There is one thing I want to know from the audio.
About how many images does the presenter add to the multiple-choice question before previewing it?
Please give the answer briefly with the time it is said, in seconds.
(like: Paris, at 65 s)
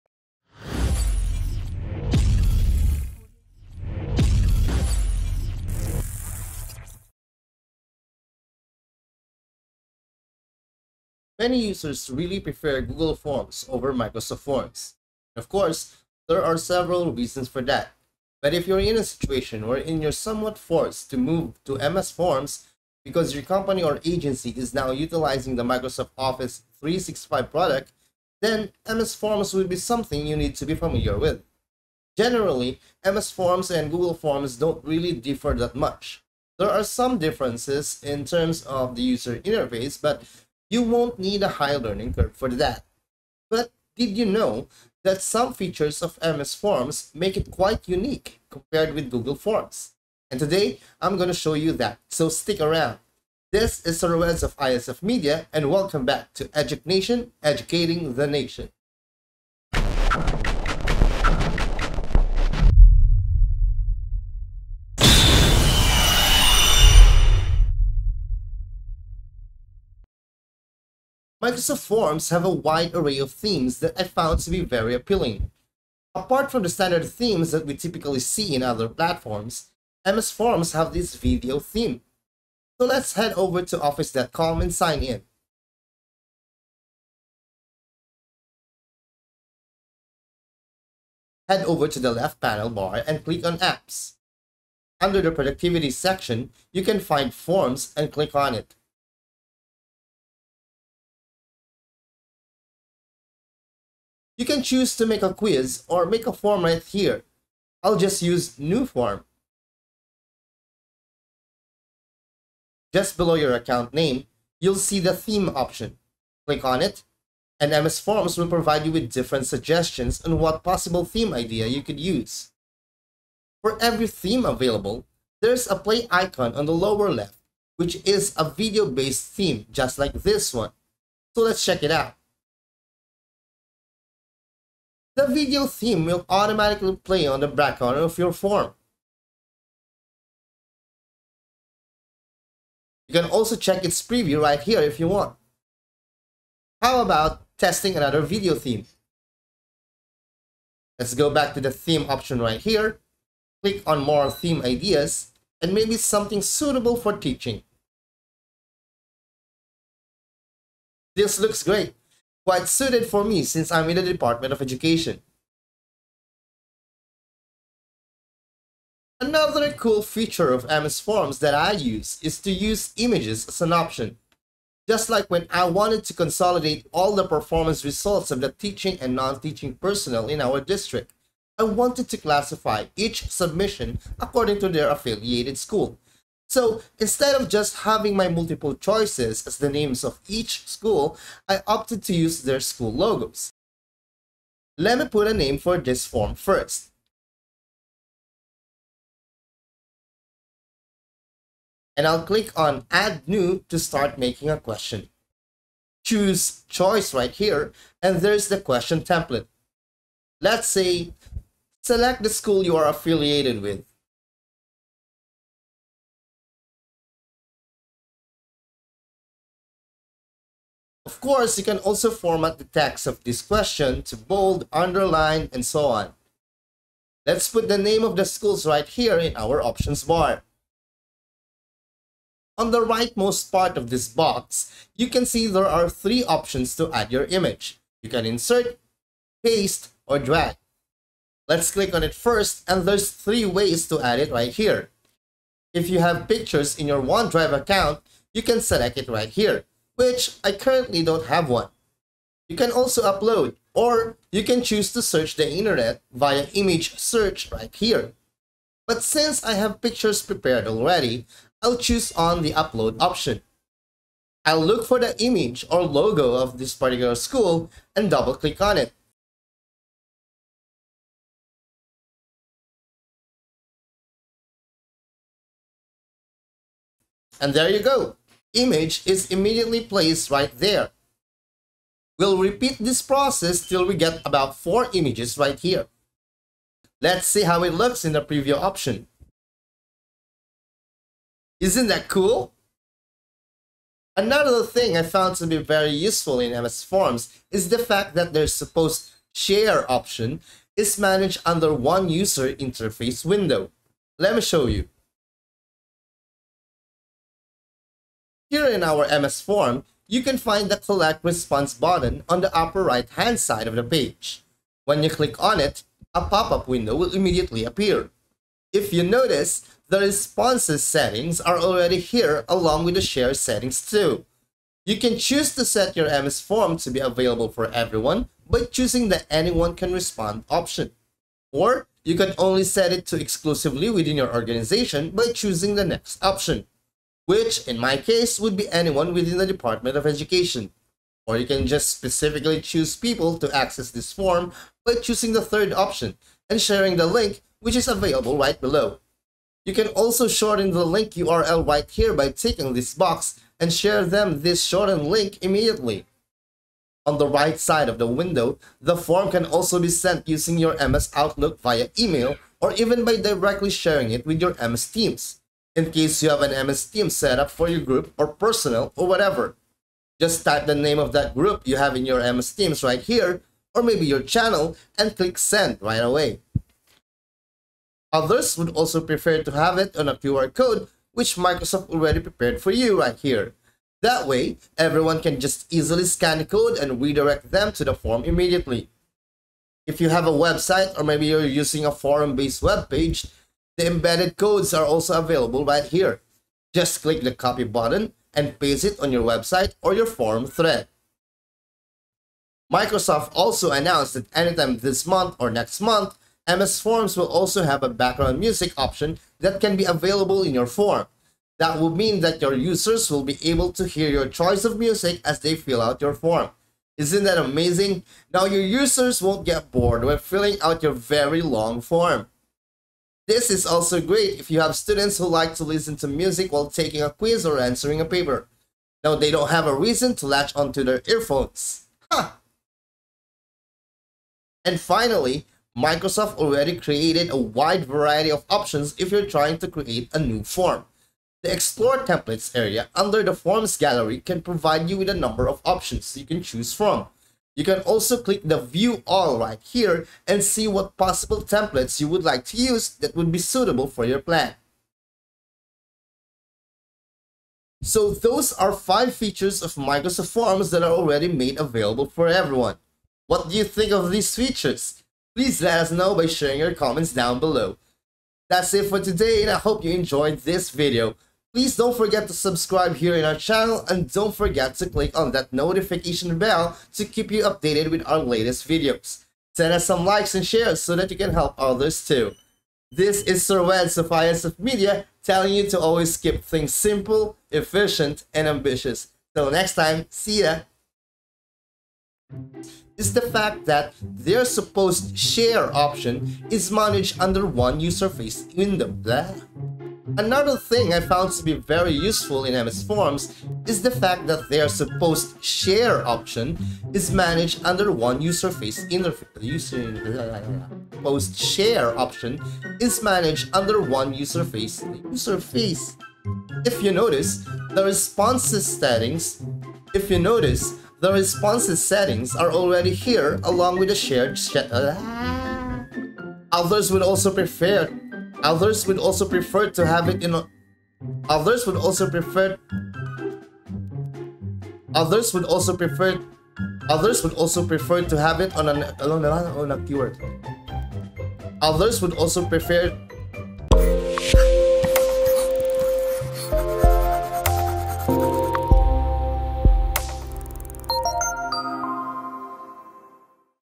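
4, at 284 s.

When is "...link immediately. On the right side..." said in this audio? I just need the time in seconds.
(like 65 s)
355 s.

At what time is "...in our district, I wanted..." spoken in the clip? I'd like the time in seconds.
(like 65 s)
180 s.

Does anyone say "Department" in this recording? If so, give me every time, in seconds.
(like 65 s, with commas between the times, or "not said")
164 s, 339 s.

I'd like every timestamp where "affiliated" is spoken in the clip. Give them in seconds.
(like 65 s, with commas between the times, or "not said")
184 s, 212 s.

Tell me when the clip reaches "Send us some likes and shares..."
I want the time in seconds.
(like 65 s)
479 s.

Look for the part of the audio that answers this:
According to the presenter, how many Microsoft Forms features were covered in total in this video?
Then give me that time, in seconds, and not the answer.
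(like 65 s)
458 s.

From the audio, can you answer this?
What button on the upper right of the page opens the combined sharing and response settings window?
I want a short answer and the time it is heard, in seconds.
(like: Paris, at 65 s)
collect response, at 310 s.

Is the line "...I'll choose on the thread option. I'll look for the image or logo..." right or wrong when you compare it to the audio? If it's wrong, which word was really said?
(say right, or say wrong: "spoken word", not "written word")
wrong: "upload", not "thread".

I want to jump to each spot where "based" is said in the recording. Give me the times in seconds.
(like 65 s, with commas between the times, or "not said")
128 s, 391 s.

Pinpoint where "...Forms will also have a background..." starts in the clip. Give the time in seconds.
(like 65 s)
406 s.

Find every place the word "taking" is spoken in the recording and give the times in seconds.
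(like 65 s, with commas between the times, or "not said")
426 s.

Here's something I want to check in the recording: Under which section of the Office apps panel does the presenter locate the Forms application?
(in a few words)
Productivity.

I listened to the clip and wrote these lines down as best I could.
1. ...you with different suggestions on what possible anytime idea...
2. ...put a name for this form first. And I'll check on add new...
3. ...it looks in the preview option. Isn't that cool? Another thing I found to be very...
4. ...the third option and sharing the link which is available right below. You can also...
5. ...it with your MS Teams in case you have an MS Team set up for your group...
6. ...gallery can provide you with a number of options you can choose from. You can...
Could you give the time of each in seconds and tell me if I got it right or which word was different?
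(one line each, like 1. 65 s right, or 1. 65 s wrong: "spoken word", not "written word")
1. 118 s wrong: "theme", not "anytime"
2. 195 s wrong: "click", not "check"
3. 287 s right
4. 345 s right
5. 364 s right
6. 443 s right.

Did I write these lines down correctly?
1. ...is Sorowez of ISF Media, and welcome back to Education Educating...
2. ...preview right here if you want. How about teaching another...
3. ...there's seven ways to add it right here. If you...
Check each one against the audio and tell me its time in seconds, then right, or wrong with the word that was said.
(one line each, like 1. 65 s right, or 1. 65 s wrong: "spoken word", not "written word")
1. 53 s right
2. 144 s wrong: "testing", not "teaching"
3. 242 s wrong: "three", not "seven".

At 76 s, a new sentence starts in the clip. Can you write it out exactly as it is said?
Apart from the standard themes that we typically see in other platforms, MS Forms have this video theme.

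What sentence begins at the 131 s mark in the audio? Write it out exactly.
So let's check it out the video theme will automatically play on the background of your form.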